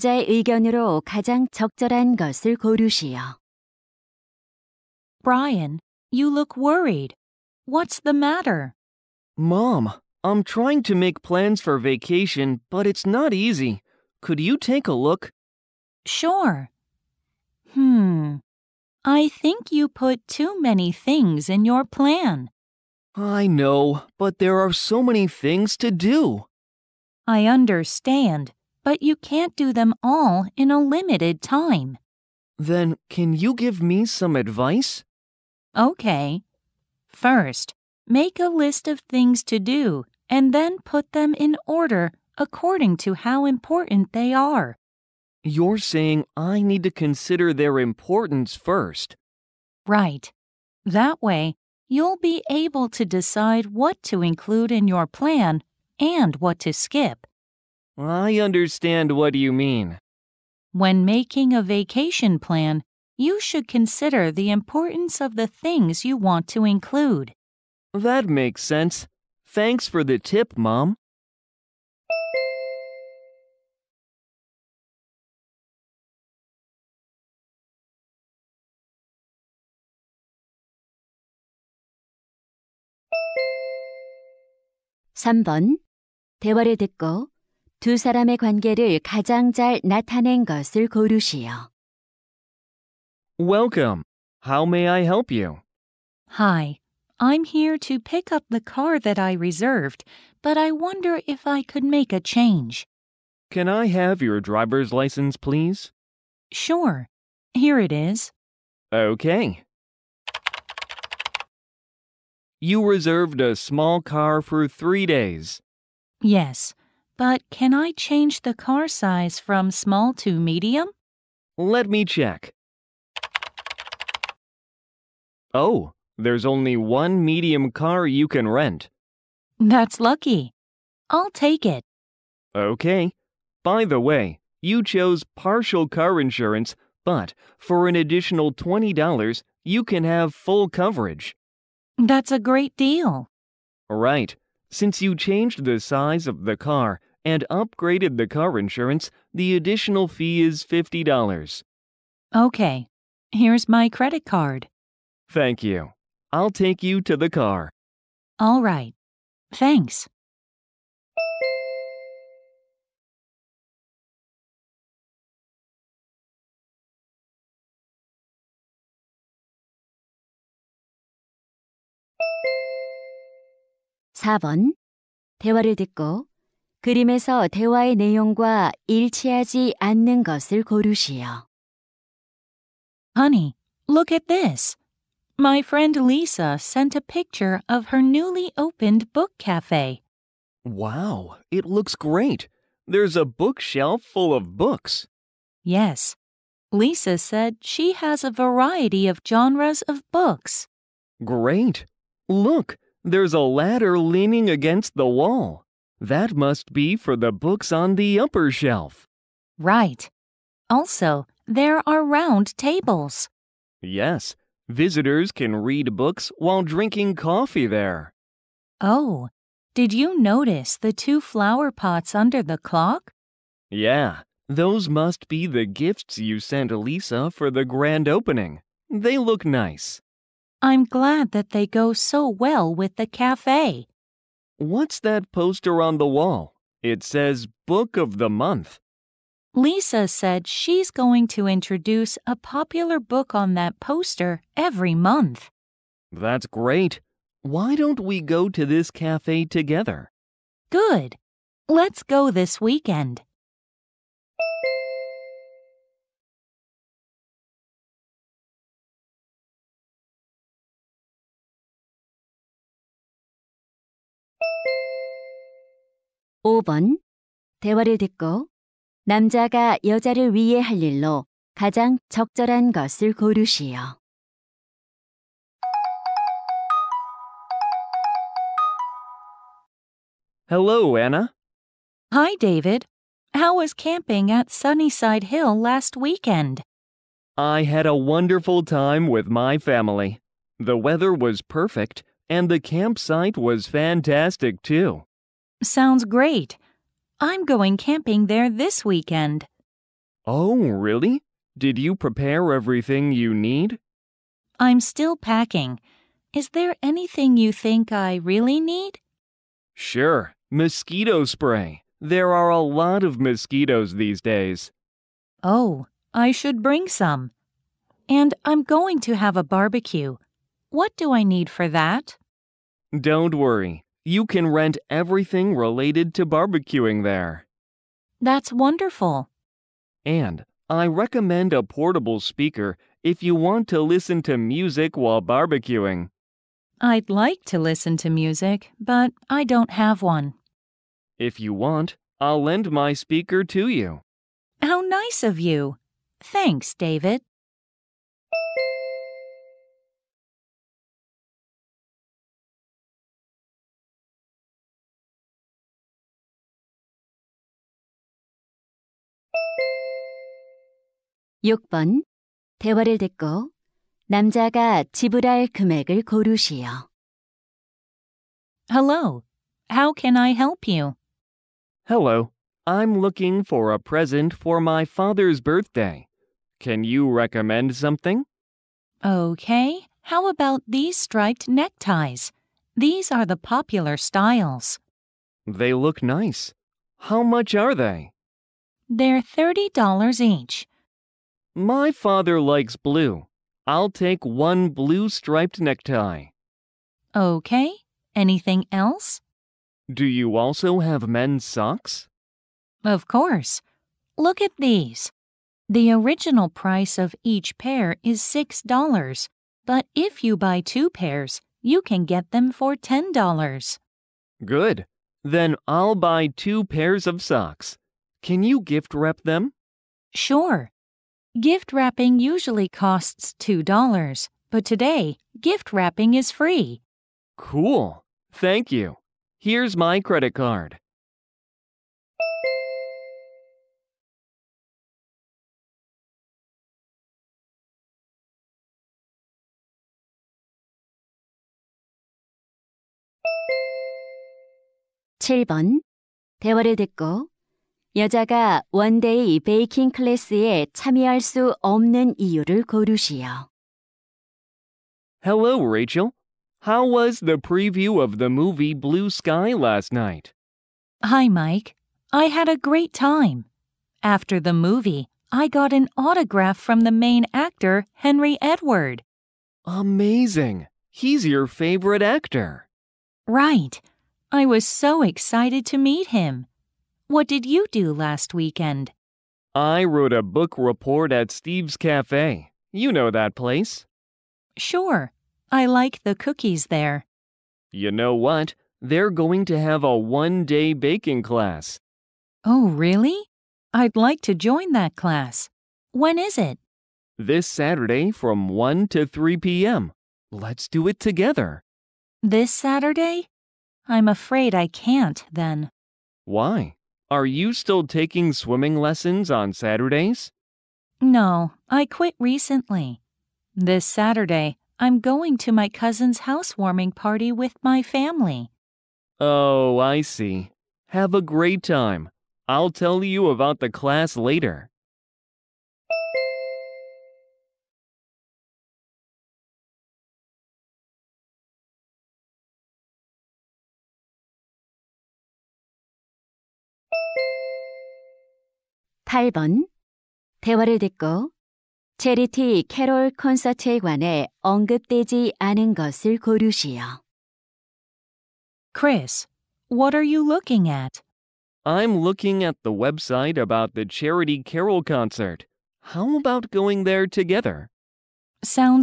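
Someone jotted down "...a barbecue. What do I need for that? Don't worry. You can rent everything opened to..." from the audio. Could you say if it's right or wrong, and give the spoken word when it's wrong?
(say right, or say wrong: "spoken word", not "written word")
wrong: "related", not "opened".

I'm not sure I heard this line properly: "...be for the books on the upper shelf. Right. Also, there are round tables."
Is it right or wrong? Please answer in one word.
right.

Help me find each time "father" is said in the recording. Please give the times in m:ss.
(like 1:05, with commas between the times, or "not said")
6:14, 6:31.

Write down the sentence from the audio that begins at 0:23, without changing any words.
I know, but there are so many things to do.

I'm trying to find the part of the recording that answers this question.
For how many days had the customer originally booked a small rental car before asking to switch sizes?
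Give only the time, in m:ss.
1:54.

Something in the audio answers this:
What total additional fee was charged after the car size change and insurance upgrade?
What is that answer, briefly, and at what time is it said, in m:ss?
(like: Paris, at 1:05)
$50, at 2:30.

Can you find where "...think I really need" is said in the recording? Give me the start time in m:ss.
5:07.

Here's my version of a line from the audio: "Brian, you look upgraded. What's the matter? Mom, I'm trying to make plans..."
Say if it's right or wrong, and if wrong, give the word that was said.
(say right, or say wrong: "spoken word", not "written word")
wrong: "worried", not "upgraded".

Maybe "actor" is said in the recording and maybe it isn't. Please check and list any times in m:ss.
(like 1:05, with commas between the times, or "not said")
7:47, 7:52.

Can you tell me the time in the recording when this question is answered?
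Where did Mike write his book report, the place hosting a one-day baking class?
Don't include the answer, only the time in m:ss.
8:01.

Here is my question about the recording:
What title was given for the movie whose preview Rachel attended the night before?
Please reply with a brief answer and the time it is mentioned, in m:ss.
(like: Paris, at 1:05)
Blue Sky, at 7:38.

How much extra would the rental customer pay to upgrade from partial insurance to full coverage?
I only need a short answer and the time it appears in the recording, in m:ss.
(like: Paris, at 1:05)
$20, at 2:18.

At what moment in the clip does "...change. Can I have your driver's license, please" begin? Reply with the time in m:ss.
1:42.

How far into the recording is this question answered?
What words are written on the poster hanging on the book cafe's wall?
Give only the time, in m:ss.
3:57.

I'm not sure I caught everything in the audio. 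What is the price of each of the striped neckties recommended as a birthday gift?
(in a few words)
$30.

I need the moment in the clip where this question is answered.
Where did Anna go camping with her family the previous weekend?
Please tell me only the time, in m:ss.
4:44.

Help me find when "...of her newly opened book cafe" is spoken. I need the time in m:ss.
3:07.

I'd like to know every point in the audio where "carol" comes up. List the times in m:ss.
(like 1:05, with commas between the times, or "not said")
9:14.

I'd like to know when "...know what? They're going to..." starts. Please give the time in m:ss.
8:07.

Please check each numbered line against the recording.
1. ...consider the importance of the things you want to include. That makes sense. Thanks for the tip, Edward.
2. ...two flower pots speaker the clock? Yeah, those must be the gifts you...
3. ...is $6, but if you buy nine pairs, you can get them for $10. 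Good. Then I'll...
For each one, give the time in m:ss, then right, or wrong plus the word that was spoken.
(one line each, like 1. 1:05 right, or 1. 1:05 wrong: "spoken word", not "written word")
1. 1:03 wrong: "Mom", not "Edward"
2. 3:40 wrong: "under", not "speaker"
3. 6:48 wrong: "two", not "nine".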